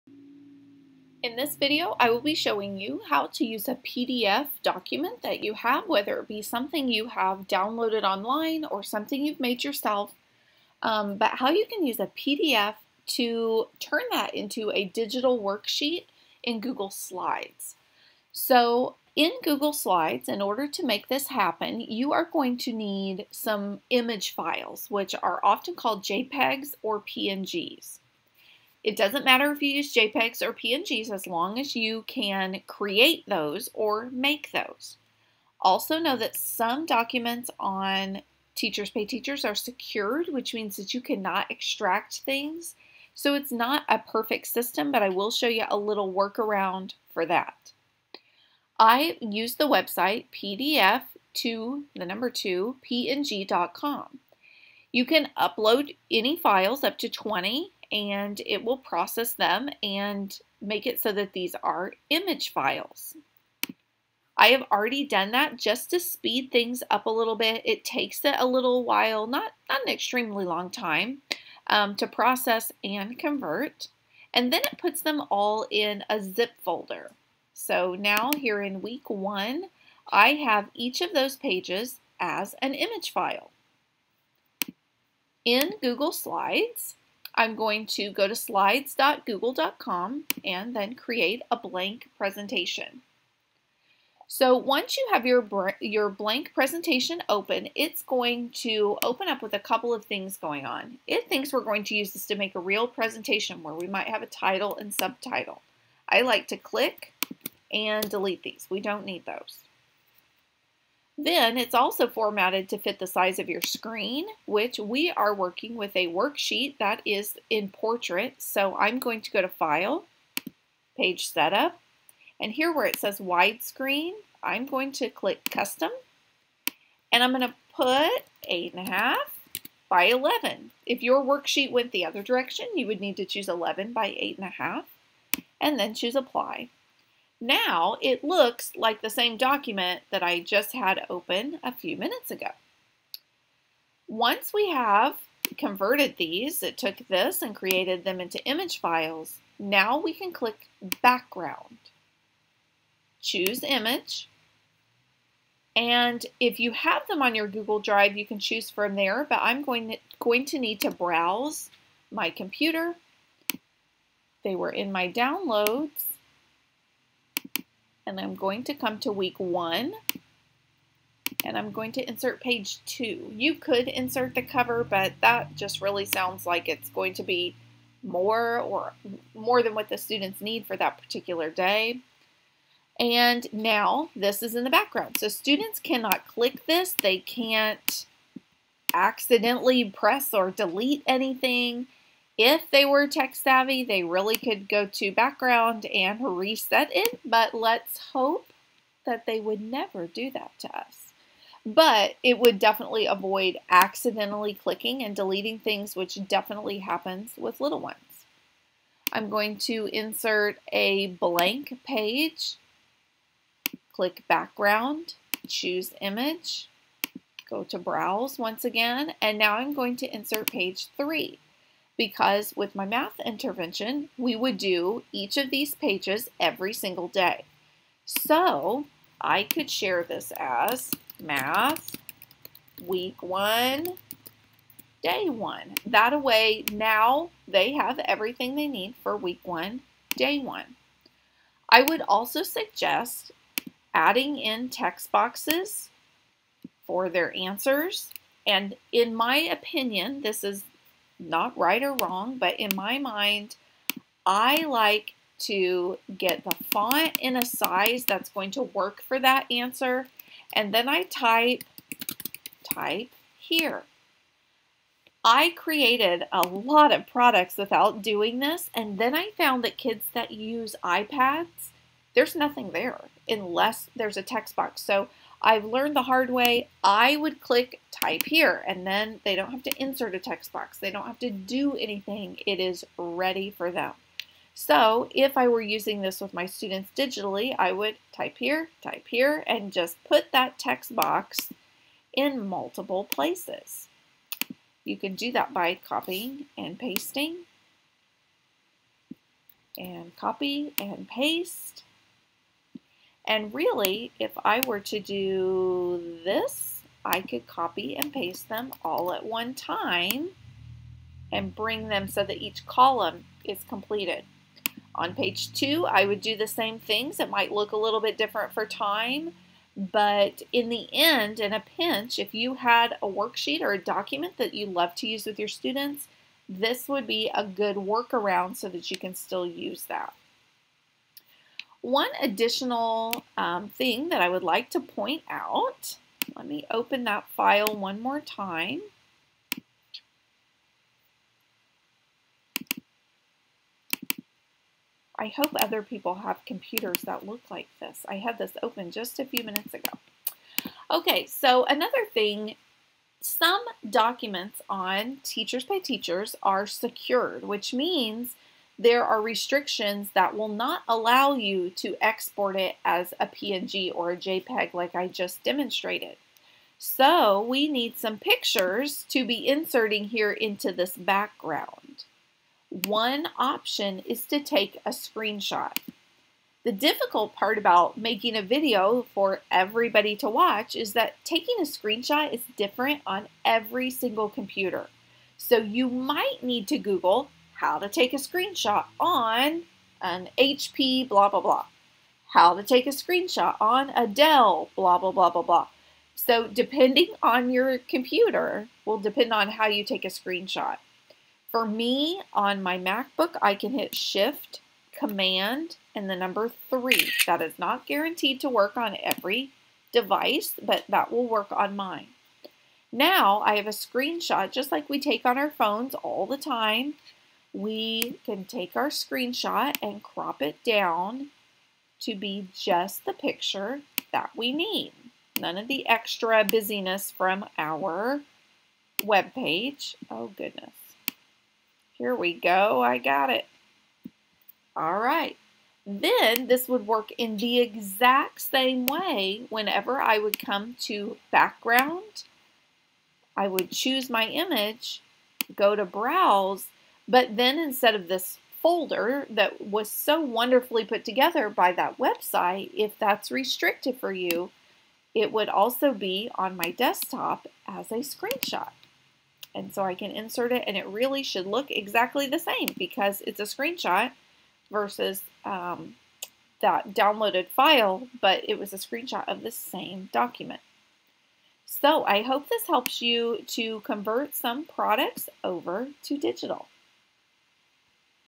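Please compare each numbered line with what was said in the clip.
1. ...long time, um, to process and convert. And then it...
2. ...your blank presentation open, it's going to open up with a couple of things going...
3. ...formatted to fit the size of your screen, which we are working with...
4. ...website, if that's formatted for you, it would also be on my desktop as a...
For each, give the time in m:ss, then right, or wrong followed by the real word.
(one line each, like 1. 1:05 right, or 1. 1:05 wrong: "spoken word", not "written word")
1. 1:10 right
2. 1:35 right
3. 1:52 right
4. 7:31 wrong: "restricted", not "formatted".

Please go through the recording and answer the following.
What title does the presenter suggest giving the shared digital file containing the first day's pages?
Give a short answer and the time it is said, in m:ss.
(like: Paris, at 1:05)
math week one, day one, at 3:51.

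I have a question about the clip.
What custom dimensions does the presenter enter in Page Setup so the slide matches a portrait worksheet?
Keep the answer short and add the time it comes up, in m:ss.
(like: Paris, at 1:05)
8.5 by 11, at 2:08.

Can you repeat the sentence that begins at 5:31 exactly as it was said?
One additional um, thing that I would like to point out, let me open that file one more time.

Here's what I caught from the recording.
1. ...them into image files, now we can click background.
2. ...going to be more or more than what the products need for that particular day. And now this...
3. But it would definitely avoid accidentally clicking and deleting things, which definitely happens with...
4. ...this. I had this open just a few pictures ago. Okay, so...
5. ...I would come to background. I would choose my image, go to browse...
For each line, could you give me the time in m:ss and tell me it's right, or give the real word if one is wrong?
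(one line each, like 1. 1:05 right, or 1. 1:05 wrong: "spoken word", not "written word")
1. 2:28 right
2. 2:56 wrong: "students", not "products"
3. 3:21 right
4. 5:47 wrong: "minutes", not "pictures"
5. 7:20 right.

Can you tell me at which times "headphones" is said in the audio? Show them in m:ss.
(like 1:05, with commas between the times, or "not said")
not said.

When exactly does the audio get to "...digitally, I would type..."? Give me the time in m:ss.
4:46.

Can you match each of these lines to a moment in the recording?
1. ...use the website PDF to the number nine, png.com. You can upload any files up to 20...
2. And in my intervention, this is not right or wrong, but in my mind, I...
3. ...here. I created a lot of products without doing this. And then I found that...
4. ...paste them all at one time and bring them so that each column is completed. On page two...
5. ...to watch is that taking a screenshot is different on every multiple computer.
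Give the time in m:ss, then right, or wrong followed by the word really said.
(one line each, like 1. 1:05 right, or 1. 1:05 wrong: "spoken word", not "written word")
1. 0:49 wrong: "two", not "nine"
2. 4:08 wrong: "opinion", not "intervention"
3. 4:23 right
4. 5:08 right
5. 6:20 wrong: "single", not "multiple".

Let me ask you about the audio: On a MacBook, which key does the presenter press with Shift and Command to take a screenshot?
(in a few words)
3.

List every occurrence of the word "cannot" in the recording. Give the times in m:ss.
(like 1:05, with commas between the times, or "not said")
0:41, 3:05.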